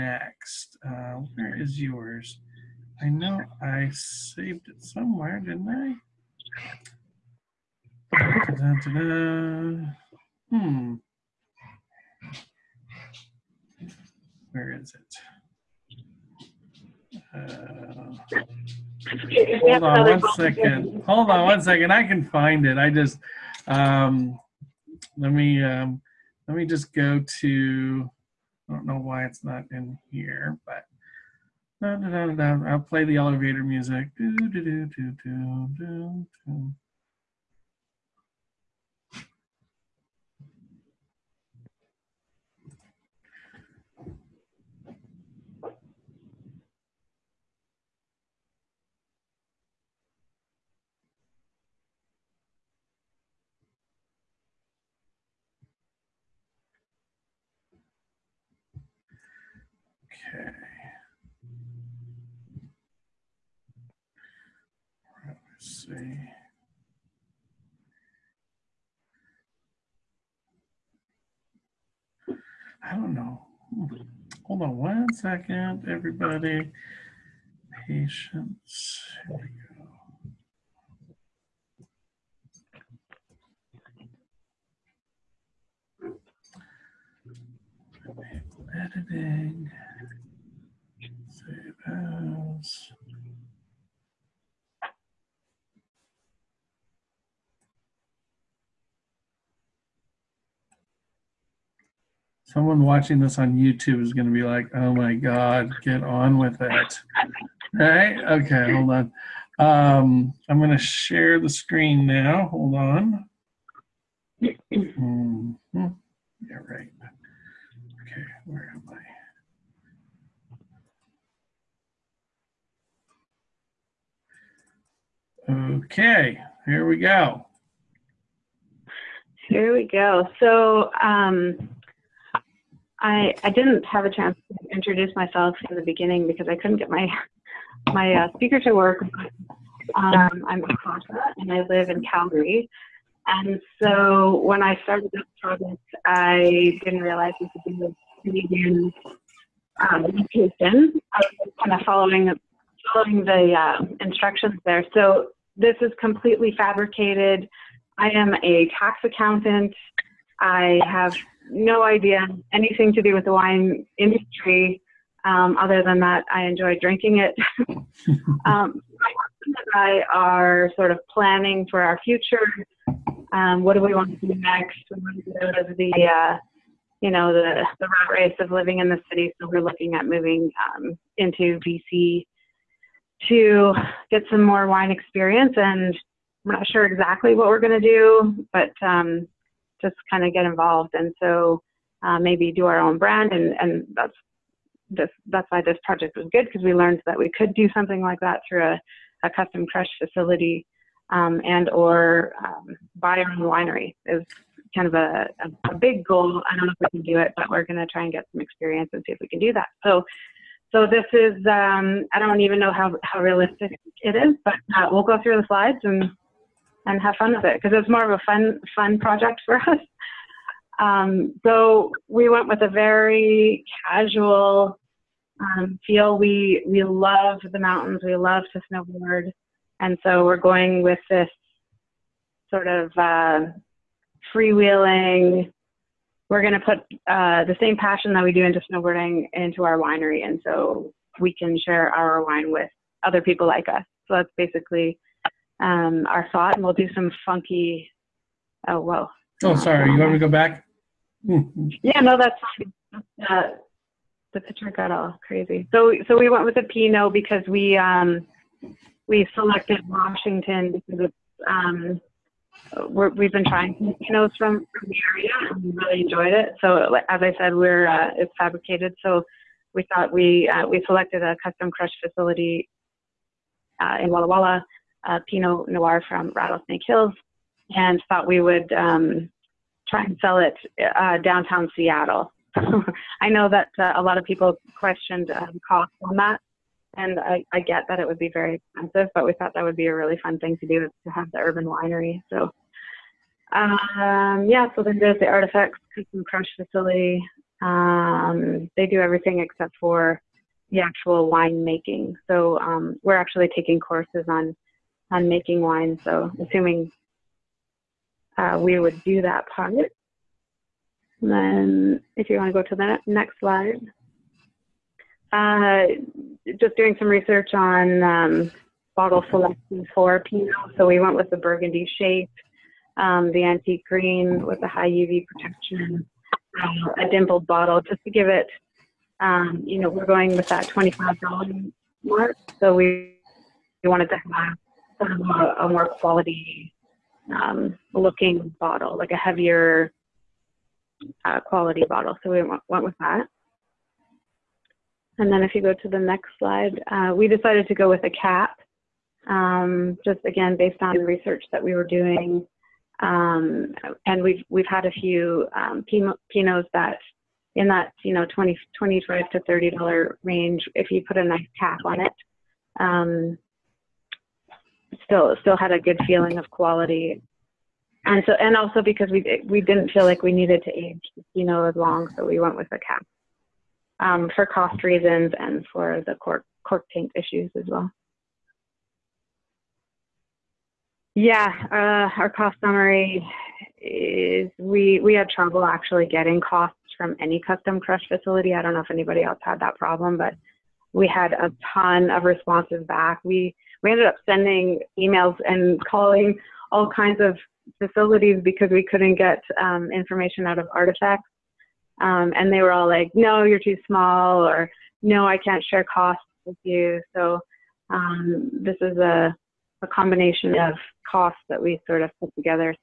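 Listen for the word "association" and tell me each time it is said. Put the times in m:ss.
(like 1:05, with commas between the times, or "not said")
not said.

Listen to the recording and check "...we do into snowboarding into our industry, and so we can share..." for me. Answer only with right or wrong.
wrong.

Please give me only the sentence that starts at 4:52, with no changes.
So, um, yeah, so then there's the Artifex, custom crush facility.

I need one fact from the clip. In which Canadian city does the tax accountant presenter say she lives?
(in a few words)
Calgary.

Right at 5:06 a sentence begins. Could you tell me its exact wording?
So assuming uh, we would do that part.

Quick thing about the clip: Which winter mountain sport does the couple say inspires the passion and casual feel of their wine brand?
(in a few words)
snowboarding.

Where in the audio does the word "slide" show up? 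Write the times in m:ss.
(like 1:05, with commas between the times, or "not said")
3:35, 5:13, 5:46.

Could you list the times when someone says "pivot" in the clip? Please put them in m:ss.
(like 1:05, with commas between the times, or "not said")
not said.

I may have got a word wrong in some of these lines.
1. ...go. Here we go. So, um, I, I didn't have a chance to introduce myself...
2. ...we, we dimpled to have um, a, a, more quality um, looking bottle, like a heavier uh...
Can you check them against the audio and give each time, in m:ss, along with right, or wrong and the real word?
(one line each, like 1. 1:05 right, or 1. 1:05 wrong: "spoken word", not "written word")
1. 2:06 right
2. 5:32 wrong: "wanted", not "dimpled".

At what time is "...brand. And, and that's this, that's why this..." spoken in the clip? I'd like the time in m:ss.
3:12.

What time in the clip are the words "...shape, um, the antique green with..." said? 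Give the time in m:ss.
5:21.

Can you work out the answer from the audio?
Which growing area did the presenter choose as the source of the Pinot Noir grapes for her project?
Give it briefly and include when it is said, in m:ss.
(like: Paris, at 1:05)
Rattlesnake Hills, at 4:36.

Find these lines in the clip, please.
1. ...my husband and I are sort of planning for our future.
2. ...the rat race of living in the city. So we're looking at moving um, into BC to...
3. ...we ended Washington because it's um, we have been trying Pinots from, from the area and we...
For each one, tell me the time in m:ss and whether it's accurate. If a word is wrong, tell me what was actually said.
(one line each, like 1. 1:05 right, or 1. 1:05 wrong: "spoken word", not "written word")
1. 2:48 right
2. 2:57 right
3. 4:19 wrong: "selected", not "ended".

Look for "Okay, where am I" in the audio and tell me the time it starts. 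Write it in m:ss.
1:58.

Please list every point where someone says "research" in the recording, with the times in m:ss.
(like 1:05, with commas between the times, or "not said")
5:17, 5:50.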